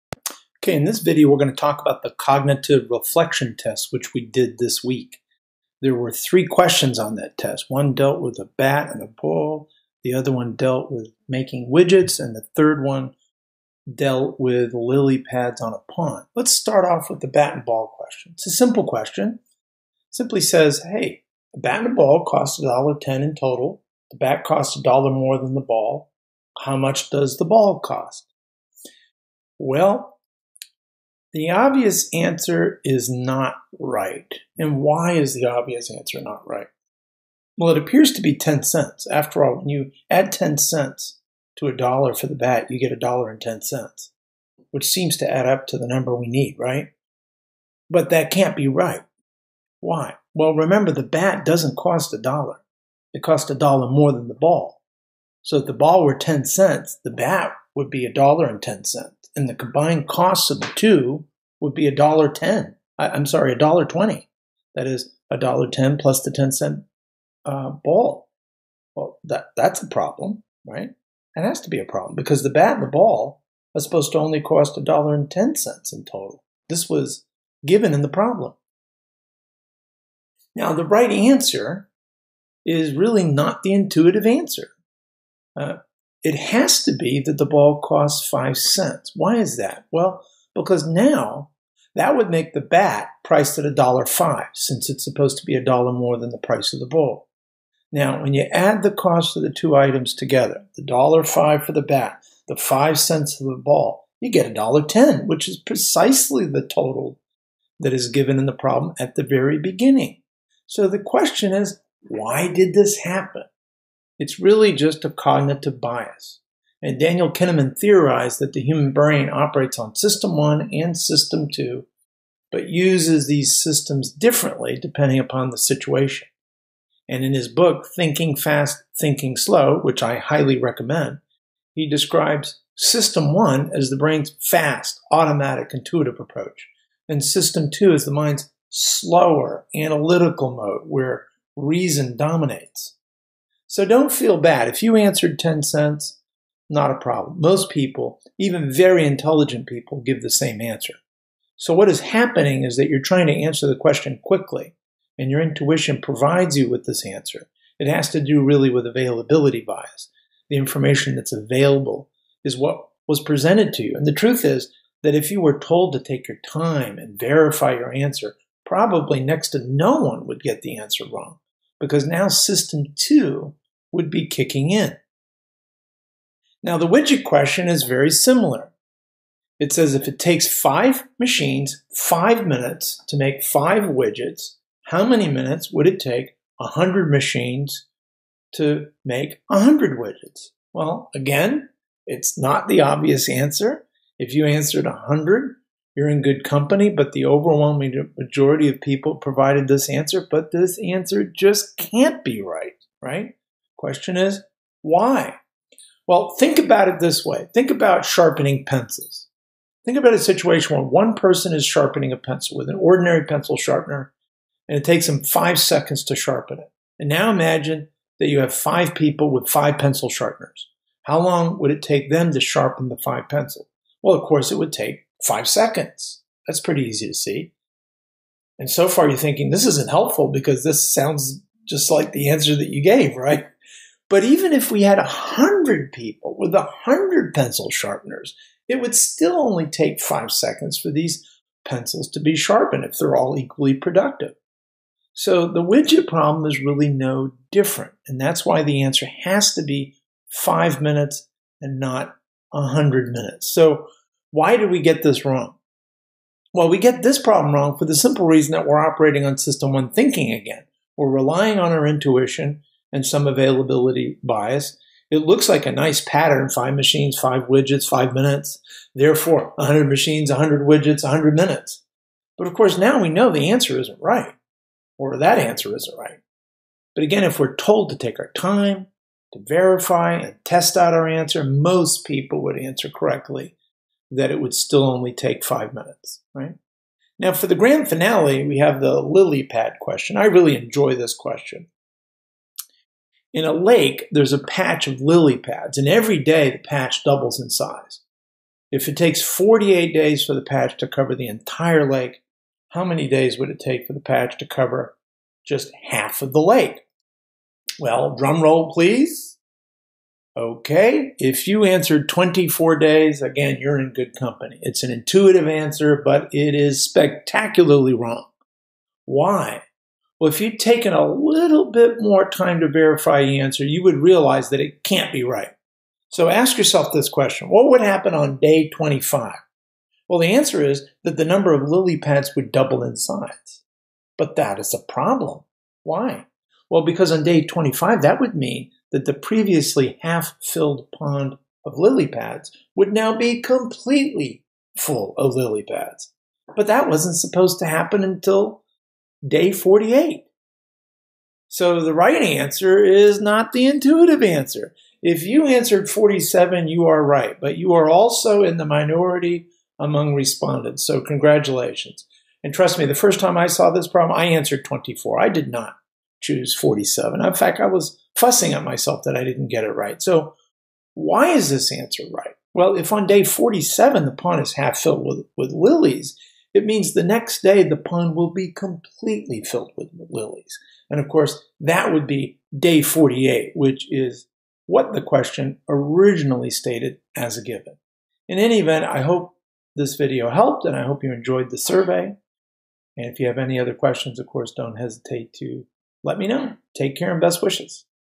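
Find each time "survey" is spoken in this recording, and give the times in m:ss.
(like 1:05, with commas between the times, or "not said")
6:31.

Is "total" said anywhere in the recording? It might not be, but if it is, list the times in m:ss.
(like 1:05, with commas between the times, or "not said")
0:23, 1:16, 1:46.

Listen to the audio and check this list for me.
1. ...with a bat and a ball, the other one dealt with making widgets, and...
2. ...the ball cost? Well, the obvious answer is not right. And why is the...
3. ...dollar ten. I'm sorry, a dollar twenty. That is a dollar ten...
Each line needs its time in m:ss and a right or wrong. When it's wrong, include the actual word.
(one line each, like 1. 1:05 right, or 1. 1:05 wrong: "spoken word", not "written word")
1. 0:08 right
2. 0:27 right
3. 1:01 right.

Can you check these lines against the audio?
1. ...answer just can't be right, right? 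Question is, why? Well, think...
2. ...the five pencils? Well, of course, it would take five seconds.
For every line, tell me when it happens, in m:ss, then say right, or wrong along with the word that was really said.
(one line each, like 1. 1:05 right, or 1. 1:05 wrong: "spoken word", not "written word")
1. 3:20 right
2. 3:42 right.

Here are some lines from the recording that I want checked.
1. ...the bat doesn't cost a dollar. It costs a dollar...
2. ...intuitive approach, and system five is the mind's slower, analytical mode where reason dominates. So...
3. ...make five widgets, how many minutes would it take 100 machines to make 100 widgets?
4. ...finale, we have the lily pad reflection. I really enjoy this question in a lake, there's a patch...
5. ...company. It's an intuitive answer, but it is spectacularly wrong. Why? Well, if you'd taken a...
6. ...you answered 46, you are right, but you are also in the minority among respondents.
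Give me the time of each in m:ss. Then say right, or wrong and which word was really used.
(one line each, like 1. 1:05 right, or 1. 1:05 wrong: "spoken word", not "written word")
1. 0:50 right
2. 2:15 wrong: "two", not "five"
3. 3:03 right
4. 4:47 wrong: "question", not "reflection"
5. 5:14 right
6. 5:55 wrong: "47", not "46".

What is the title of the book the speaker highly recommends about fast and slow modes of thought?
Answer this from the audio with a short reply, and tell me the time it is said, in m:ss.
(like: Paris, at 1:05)
Thinking Fast, Thinking Slow, at 2:07.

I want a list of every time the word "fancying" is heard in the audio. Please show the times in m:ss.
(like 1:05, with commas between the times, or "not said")
not said.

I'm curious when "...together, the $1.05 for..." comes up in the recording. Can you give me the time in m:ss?
1:40.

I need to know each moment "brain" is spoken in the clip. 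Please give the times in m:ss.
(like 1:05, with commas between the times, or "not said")
1:58, 2:13.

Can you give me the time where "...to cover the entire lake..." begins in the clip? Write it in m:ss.
5:00.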